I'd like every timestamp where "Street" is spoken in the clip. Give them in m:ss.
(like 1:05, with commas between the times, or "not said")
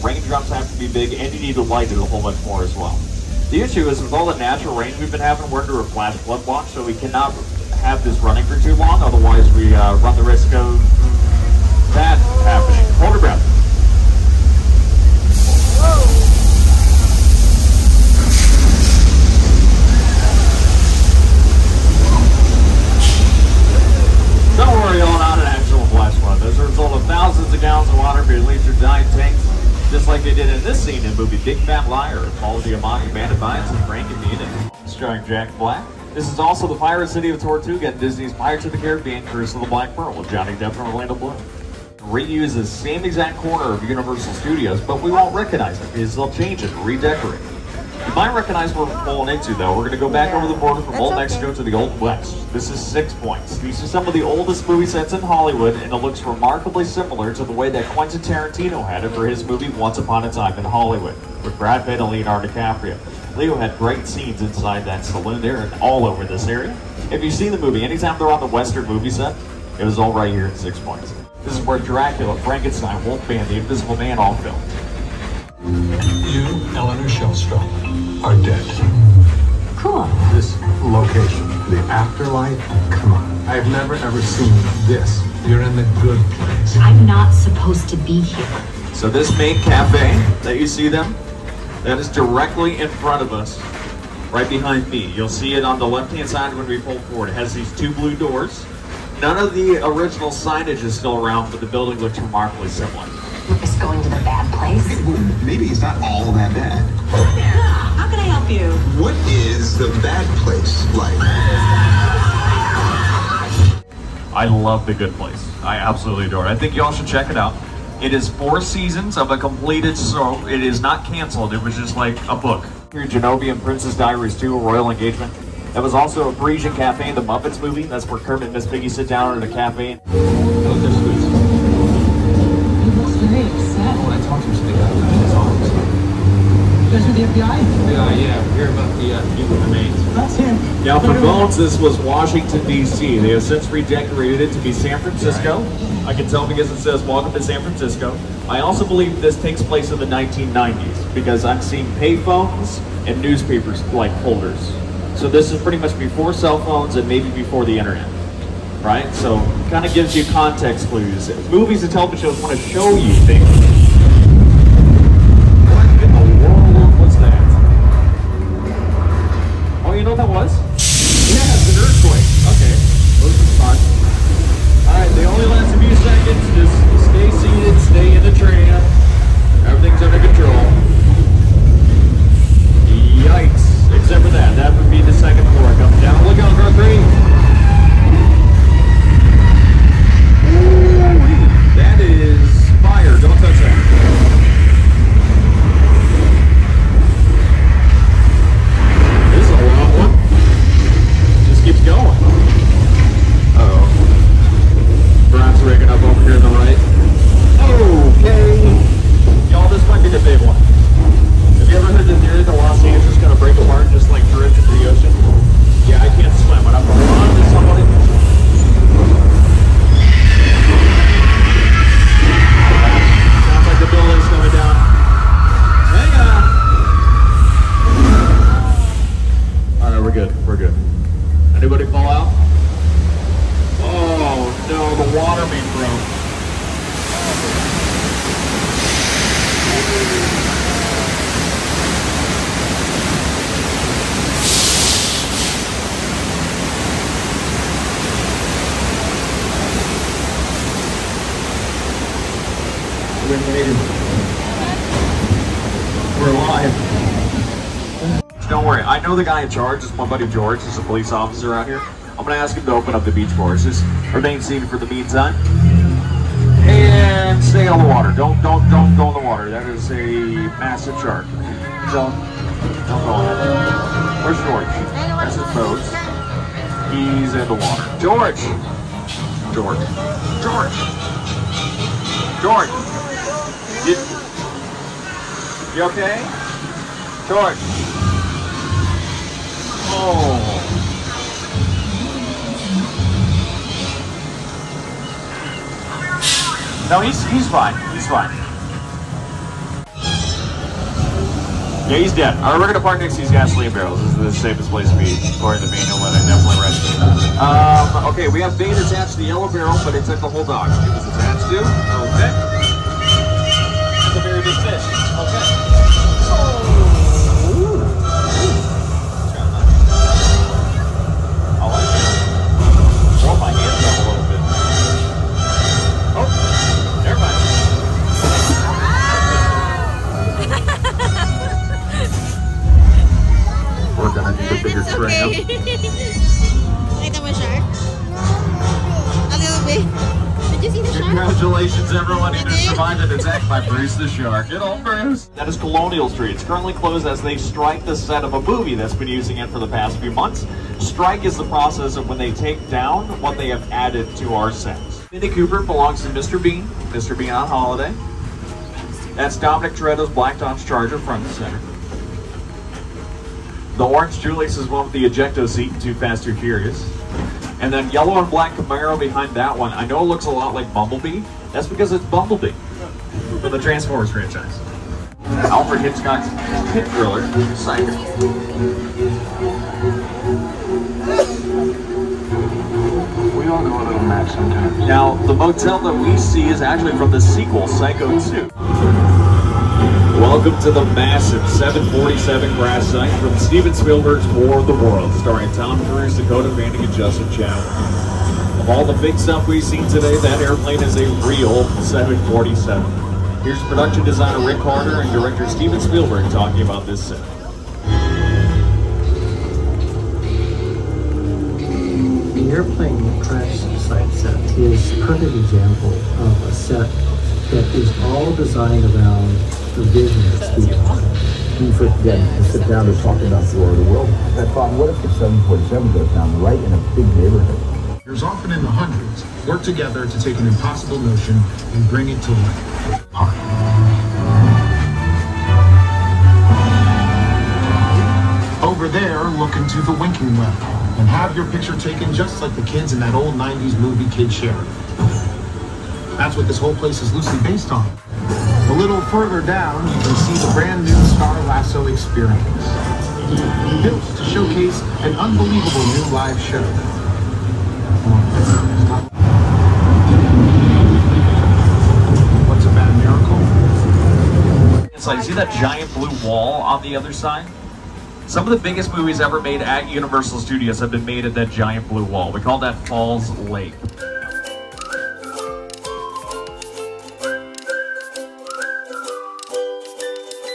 5:46.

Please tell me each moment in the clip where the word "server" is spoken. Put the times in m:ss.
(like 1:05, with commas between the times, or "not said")
not said.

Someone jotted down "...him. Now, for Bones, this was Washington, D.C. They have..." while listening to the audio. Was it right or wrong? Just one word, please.
right.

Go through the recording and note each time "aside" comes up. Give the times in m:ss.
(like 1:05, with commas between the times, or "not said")
not said.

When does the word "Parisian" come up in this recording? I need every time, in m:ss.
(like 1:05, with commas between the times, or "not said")
2:06.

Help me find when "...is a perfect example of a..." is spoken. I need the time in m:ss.
6:54.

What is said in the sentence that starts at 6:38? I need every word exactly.
Of all the big stuff we've seen today, that airplane is a real 747.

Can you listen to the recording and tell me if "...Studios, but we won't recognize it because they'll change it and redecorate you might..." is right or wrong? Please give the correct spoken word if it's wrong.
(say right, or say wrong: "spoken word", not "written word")
right.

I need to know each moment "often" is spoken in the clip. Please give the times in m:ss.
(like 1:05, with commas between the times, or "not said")
7:08.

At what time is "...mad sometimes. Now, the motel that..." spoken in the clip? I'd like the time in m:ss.
6:24.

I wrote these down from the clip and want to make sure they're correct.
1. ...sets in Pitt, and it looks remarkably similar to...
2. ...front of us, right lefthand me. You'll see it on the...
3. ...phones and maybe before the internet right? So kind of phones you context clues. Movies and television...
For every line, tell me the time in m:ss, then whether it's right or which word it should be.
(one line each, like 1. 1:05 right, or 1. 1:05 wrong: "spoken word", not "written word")
1. 0:54 wrong: "Hollywood", not "Pitt"
2. 1:32 wrong: "behind", not "lefthand"
3. 2:36 wrong: "gives", not "phones".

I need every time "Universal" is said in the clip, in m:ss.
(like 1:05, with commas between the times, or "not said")
0:43, 7:49.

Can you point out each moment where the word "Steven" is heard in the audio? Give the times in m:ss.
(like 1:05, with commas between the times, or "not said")
6:33, 6:45.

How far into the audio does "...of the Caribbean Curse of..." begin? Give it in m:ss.
0:38.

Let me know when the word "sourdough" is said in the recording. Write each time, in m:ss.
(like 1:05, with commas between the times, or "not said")
not said.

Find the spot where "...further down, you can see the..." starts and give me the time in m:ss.
7:28.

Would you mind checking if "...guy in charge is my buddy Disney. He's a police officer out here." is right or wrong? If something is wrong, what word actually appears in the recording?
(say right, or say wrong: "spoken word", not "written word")
wrong: "George", not "Disney".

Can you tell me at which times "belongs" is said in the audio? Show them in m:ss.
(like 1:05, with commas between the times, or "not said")
5:55.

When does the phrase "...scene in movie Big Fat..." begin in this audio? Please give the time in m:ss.
0:30.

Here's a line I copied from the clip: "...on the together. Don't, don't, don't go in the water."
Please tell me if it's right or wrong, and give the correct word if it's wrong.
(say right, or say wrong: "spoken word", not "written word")
wrong: "water", not "together".